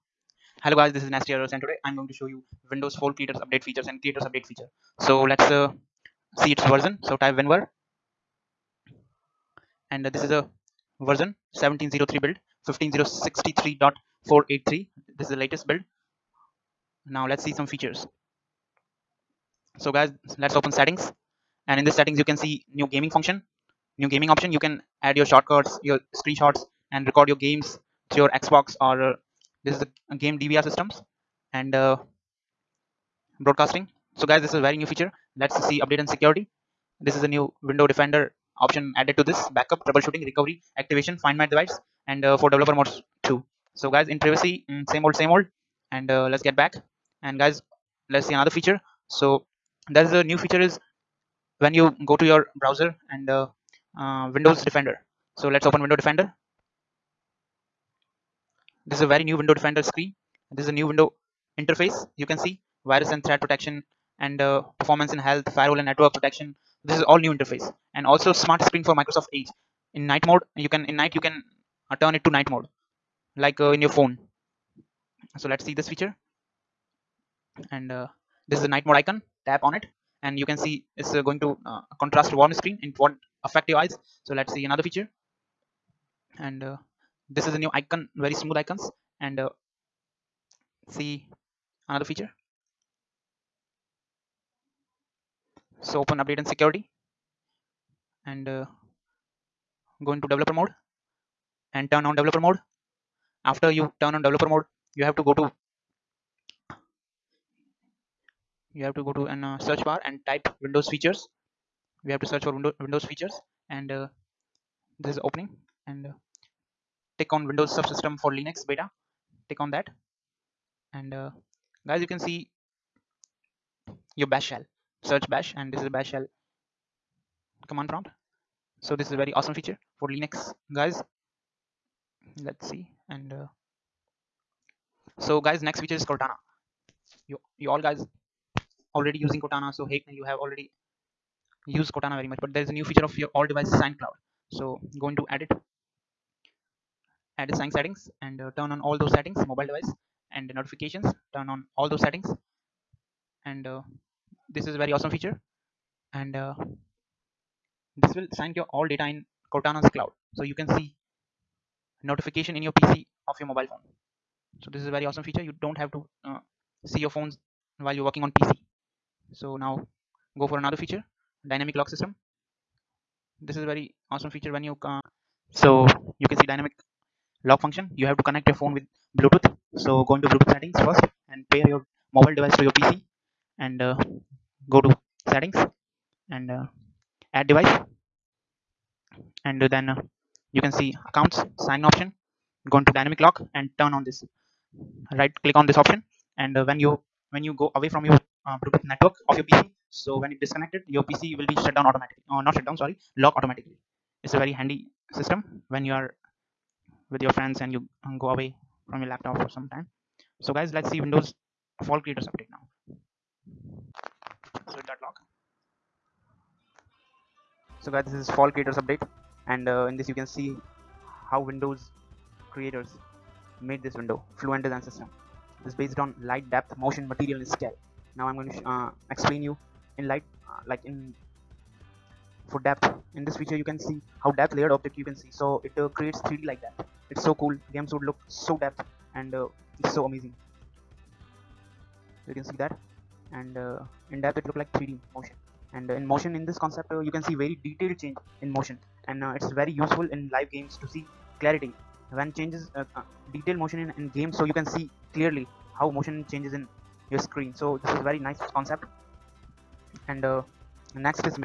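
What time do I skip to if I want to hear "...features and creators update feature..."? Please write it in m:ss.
0:03.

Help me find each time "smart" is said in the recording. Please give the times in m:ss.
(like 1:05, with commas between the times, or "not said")
1:08.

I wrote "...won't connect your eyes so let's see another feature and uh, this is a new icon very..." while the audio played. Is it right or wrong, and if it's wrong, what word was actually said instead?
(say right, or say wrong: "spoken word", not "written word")
wrong: "affect", not "connect".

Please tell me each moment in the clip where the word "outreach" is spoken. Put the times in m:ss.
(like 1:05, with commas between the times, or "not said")
not said.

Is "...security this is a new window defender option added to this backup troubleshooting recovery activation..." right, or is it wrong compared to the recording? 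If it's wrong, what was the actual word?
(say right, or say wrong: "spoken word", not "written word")
right.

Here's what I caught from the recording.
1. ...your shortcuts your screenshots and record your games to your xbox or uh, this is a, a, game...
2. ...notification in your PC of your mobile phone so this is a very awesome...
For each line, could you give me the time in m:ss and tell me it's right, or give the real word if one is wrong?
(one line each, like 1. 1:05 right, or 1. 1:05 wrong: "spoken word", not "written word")
1. 0:25 right
2. 2:42 right.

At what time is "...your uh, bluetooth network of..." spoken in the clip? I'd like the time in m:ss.
3:18.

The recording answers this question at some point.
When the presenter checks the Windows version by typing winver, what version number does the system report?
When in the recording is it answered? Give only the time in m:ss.
0:11.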